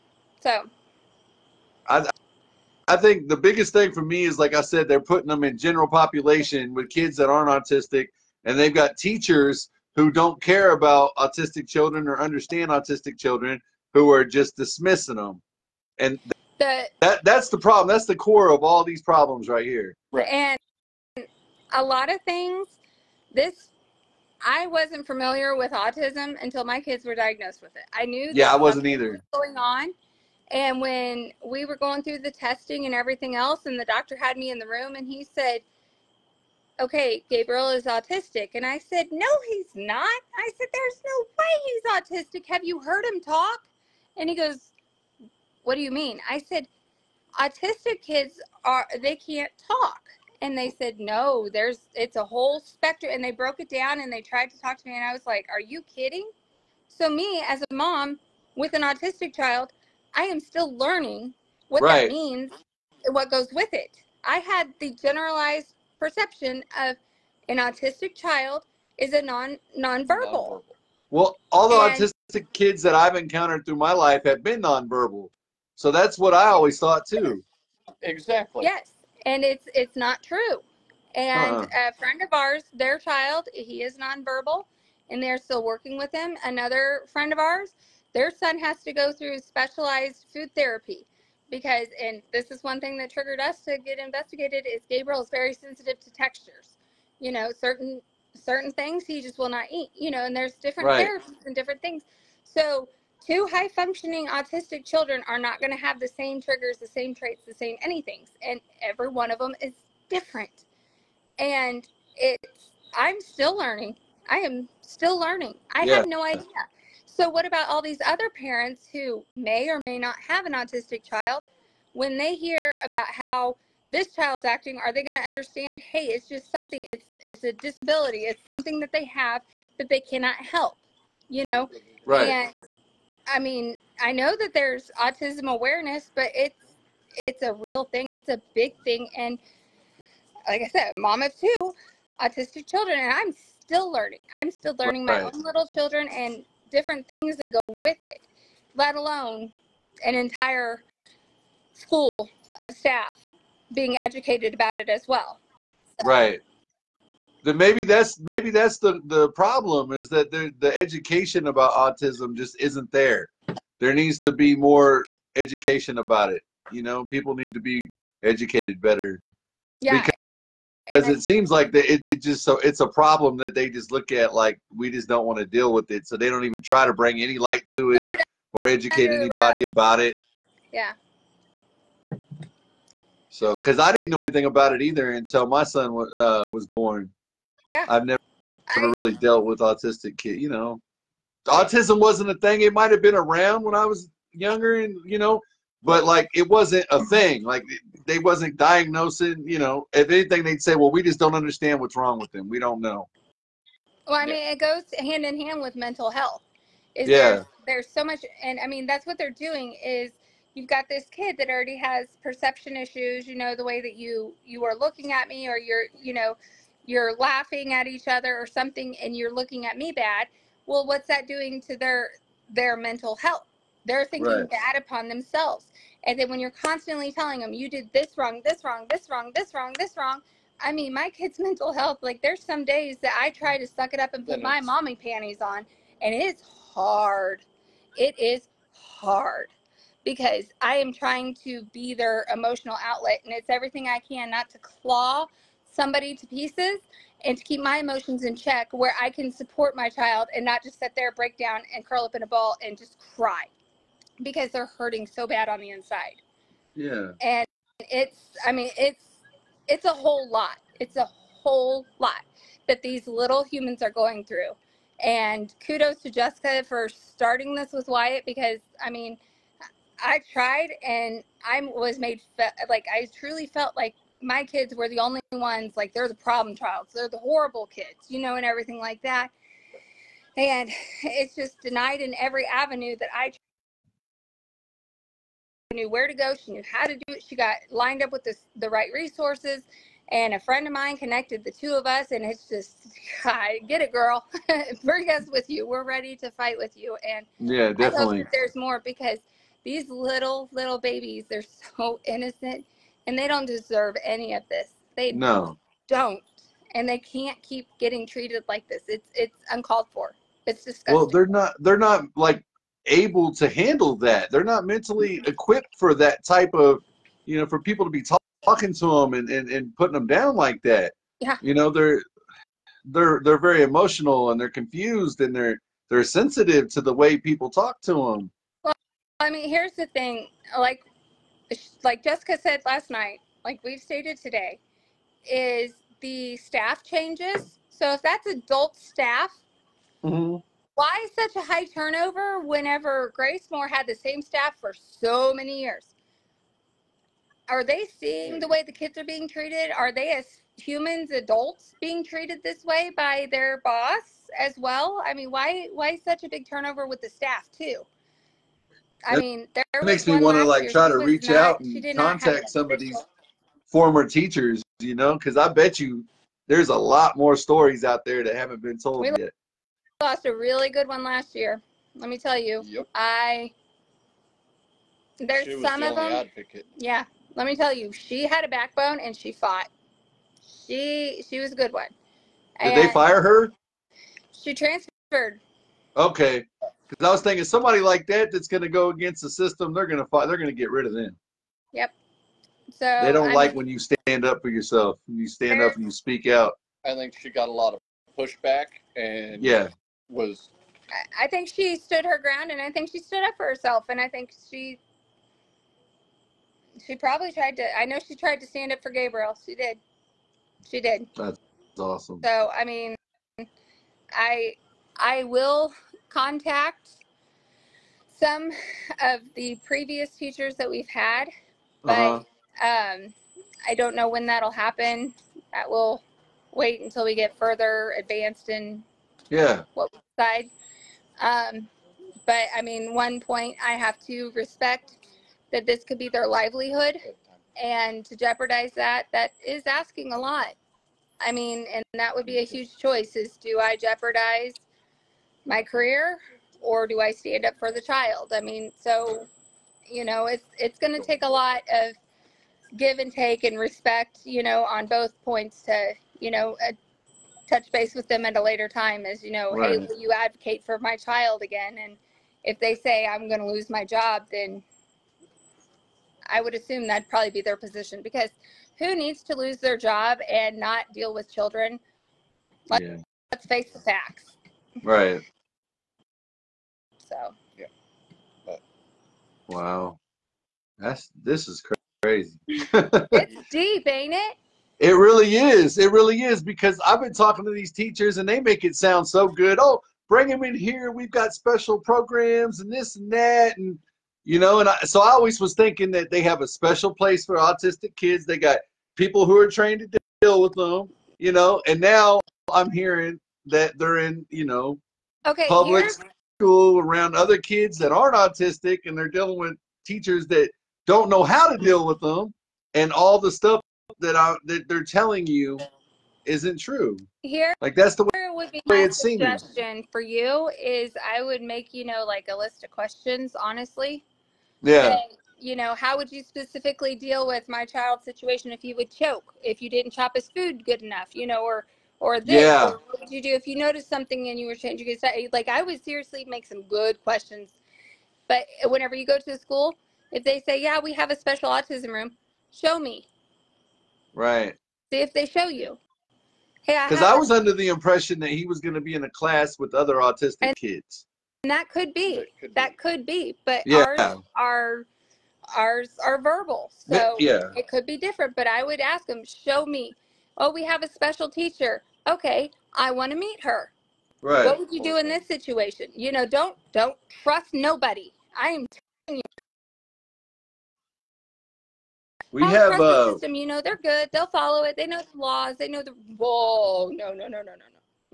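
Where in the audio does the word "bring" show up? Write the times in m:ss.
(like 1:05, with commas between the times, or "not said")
2:56, 4:54, 8:10.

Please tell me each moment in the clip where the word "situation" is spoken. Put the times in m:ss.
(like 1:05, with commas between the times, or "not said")
8:48, 9:25.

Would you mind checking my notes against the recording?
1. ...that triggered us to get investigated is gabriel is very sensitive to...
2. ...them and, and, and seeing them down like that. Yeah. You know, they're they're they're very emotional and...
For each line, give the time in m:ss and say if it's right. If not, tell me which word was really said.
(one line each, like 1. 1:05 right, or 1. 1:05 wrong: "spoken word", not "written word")
1. 1:32 right
2. 5:19 wrong: "putting", not "seeing".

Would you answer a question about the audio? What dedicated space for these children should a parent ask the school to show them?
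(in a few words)
A special autism room.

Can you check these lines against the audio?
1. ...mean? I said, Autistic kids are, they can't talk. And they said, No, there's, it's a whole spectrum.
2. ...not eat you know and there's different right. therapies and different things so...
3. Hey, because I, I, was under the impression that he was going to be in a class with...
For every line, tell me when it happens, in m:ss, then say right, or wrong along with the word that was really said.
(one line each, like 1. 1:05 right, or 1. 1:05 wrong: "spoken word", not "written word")
1. 0:45 right
2. 1:39 right
3. 9:06 right.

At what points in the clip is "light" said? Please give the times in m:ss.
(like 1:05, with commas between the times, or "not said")
2:57.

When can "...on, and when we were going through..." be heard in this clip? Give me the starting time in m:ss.
0:29.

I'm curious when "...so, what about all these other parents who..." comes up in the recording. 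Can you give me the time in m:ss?
1:57.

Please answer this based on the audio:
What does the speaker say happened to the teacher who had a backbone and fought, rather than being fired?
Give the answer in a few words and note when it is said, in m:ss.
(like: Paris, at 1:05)
Transferred, at 6:24.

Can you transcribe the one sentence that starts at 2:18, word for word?
It's a big thing, and like I said, mom of two autistic children, and I'm still learning.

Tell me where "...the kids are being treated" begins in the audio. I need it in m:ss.
5:48.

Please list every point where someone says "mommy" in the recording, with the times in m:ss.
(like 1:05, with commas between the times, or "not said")
3:54.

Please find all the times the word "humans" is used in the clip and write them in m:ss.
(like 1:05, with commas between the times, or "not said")
4:23, 5:50.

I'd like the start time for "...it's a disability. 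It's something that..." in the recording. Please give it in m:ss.
2:07.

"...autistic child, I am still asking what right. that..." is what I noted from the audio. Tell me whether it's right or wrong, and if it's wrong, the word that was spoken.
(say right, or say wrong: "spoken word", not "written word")
wrong: "learning", not "asking".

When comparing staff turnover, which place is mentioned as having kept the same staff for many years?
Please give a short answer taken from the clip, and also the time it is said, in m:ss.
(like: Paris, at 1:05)
Gracemor, at 5:43.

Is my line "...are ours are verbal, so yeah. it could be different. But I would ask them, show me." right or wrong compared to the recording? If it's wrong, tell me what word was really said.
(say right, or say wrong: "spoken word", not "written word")
right.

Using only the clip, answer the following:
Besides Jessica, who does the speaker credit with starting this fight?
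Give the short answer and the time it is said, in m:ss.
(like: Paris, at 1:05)
Wyatt, at 4:27.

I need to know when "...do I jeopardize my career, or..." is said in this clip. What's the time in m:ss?
7:23.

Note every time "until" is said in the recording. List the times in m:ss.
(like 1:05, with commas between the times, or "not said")
0:26, 3:05, 7:06.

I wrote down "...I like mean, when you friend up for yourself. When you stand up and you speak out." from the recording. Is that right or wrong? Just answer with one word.
wrong.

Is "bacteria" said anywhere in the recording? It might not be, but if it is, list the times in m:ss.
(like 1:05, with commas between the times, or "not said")
not said.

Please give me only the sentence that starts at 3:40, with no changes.
Well, what's that doing to their their mental health?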